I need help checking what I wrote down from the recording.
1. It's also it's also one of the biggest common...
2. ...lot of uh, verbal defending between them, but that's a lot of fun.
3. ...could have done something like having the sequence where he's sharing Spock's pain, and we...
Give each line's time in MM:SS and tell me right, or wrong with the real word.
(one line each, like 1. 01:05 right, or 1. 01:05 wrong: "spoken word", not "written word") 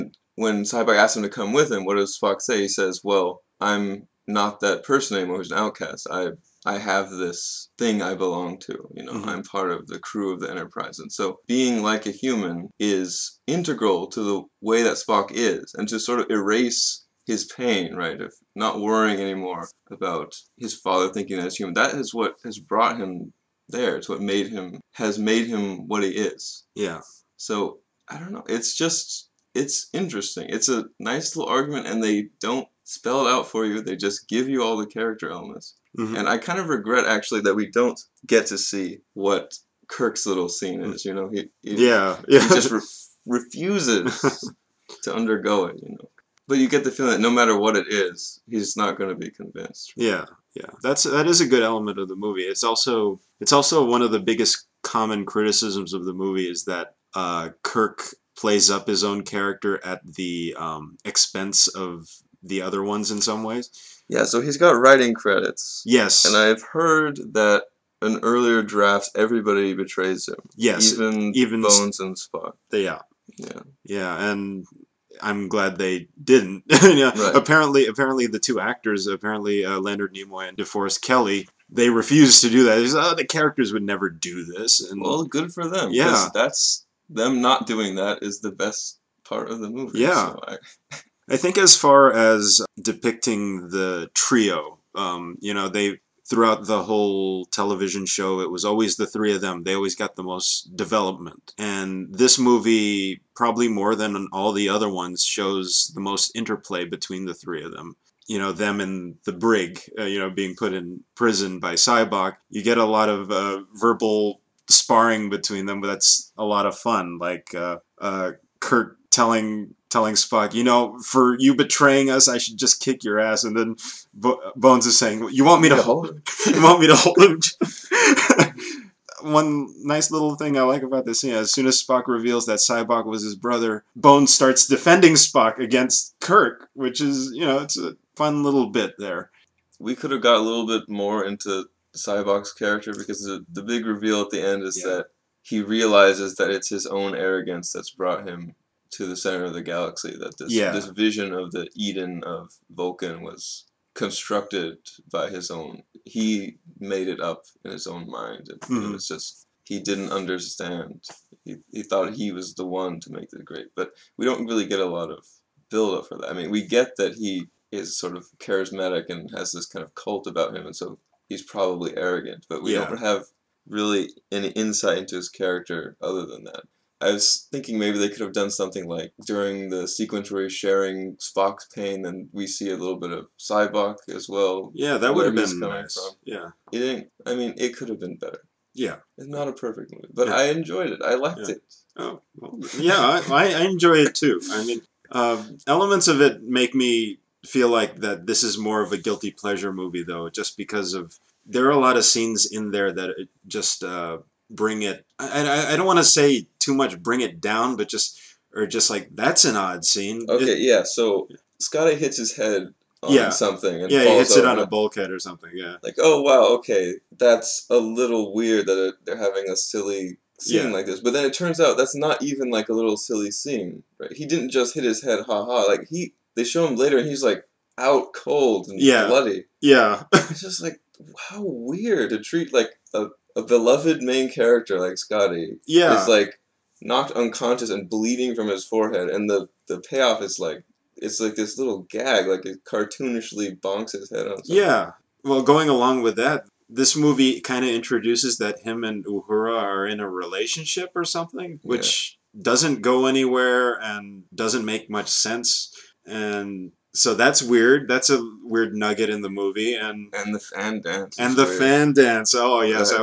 1. 00:52 right
2. 01:52 wrong: "sparring", not "defending"
3. 02:58 wrong: "during", not "having".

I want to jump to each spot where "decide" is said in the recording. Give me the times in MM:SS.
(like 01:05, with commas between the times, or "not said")
not said.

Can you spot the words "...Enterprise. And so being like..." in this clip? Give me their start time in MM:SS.
00:10.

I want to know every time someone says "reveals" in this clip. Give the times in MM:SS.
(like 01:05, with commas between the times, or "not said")
02:12, 02:23.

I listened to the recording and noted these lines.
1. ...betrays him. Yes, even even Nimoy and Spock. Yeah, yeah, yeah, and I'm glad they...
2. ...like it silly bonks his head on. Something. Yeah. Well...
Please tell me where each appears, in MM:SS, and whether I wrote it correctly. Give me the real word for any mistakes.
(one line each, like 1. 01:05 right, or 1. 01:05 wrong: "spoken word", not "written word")
1. 01:09 wrong: "Bones", not "Nimoy"
2. 04:02 wrong: "cartoonishly", not "silly".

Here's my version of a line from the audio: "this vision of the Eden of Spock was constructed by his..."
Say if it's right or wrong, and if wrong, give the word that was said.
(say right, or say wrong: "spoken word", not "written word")
wrong: "Vulcan", not "Spock".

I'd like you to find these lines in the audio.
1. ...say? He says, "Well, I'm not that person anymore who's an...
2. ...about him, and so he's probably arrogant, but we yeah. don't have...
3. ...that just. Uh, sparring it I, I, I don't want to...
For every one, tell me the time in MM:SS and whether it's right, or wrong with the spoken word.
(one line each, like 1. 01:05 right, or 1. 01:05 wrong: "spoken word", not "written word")
1. 00:02 right
2. 02:50 right
3. 03:22 wrong: "bring", not "sparring".